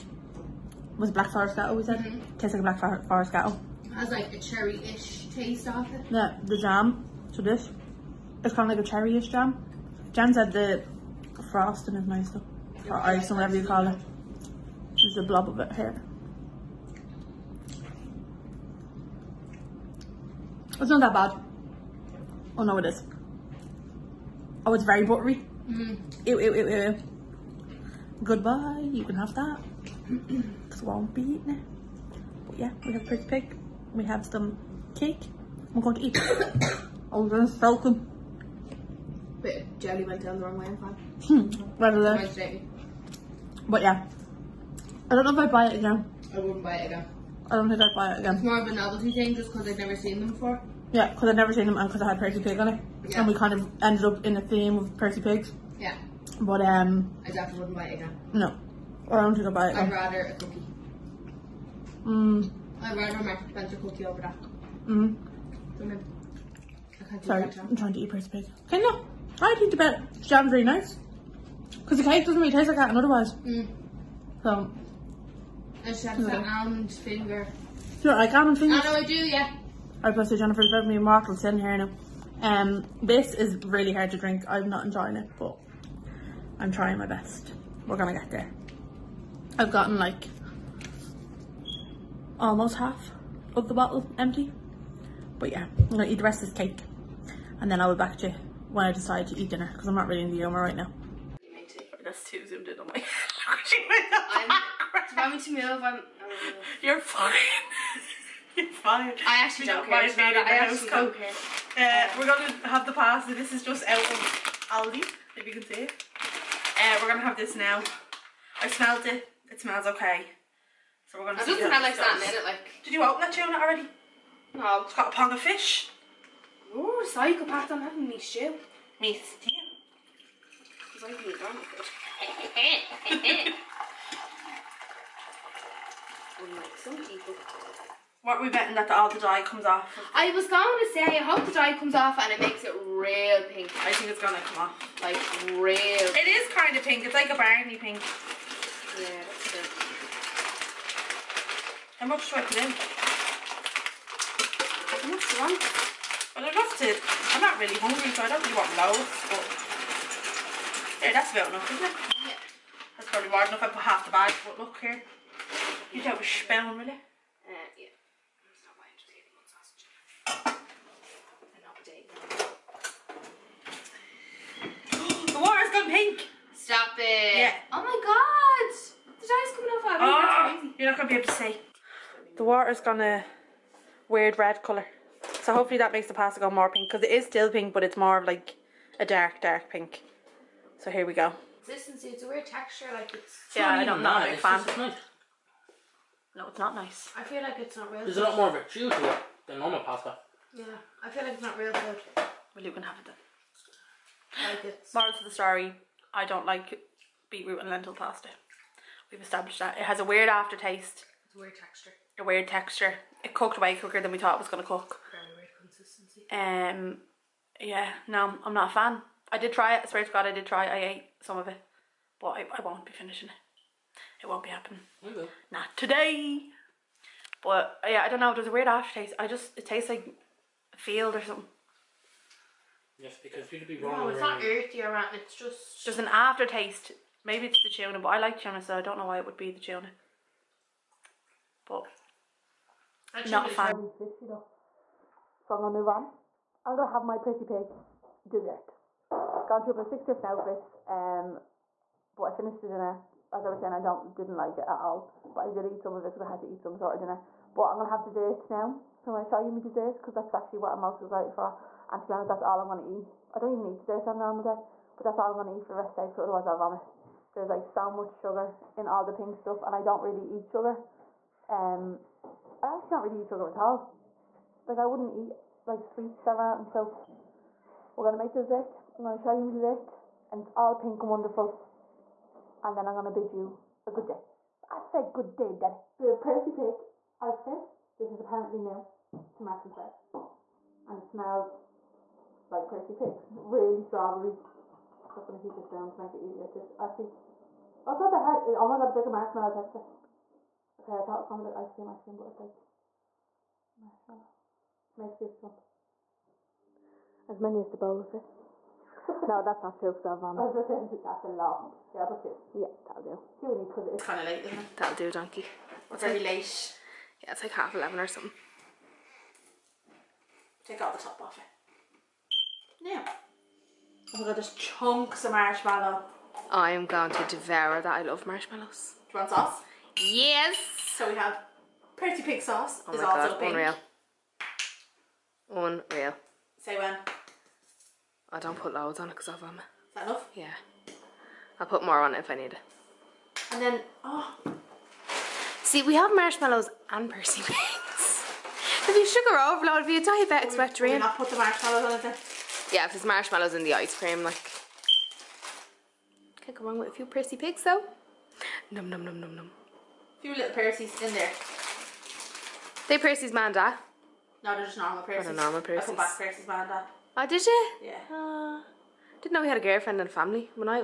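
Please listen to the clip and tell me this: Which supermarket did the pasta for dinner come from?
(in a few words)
Aldi.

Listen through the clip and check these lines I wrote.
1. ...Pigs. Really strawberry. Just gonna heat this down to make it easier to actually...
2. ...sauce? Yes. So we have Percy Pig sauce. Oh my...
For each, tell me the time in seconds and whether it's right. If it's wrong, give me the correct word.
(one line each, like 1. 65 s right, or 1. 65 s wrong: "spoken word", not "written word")
1. 292 s right
2. 329 s right.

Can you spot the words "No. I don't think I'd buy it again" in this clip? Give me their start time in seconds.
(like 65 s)
58 s.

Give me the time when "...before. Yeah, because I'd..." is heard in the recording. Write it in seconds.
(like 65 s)
50 s.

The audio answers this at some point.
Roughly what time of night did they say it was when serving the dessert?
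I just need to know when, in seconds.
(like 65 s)
317 s.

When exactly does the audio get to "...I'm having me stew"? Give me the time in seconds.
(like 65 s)
127 s.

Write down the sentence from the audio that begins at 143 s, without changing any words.
I think it's going to come off.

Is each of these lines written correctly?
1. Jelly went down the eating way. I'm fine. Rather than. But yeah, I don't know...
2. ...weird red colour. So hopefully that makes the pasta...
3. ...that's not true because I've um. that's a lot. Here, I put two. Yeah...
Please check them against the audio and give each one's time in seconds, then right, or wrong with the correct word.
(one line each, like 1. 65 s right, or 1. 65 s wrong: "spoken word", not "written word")
1. 39 s wrong: "wrong", not "eating"
2. 184 s right
3. 309 s right.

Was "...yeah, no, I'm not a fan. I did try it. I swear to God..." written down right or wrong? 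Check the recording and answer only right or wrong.
right.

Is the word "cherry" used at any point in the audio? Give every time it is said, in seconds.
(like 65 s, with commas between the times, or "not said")
4 s, 8 s.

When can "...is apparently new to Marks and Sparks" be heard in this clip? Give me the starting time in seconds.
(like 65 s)
288 s.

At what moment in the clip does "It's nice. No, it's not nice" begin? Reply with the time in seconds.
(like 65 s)
194 s.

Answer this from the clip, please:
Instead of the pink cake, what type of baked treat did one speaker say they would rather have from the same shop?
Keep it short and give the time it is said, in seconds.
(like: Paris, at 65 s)
Spencer cookie, at 63 s.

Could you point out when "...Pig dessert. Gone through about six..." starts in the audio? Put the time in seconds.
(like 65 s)
247 s.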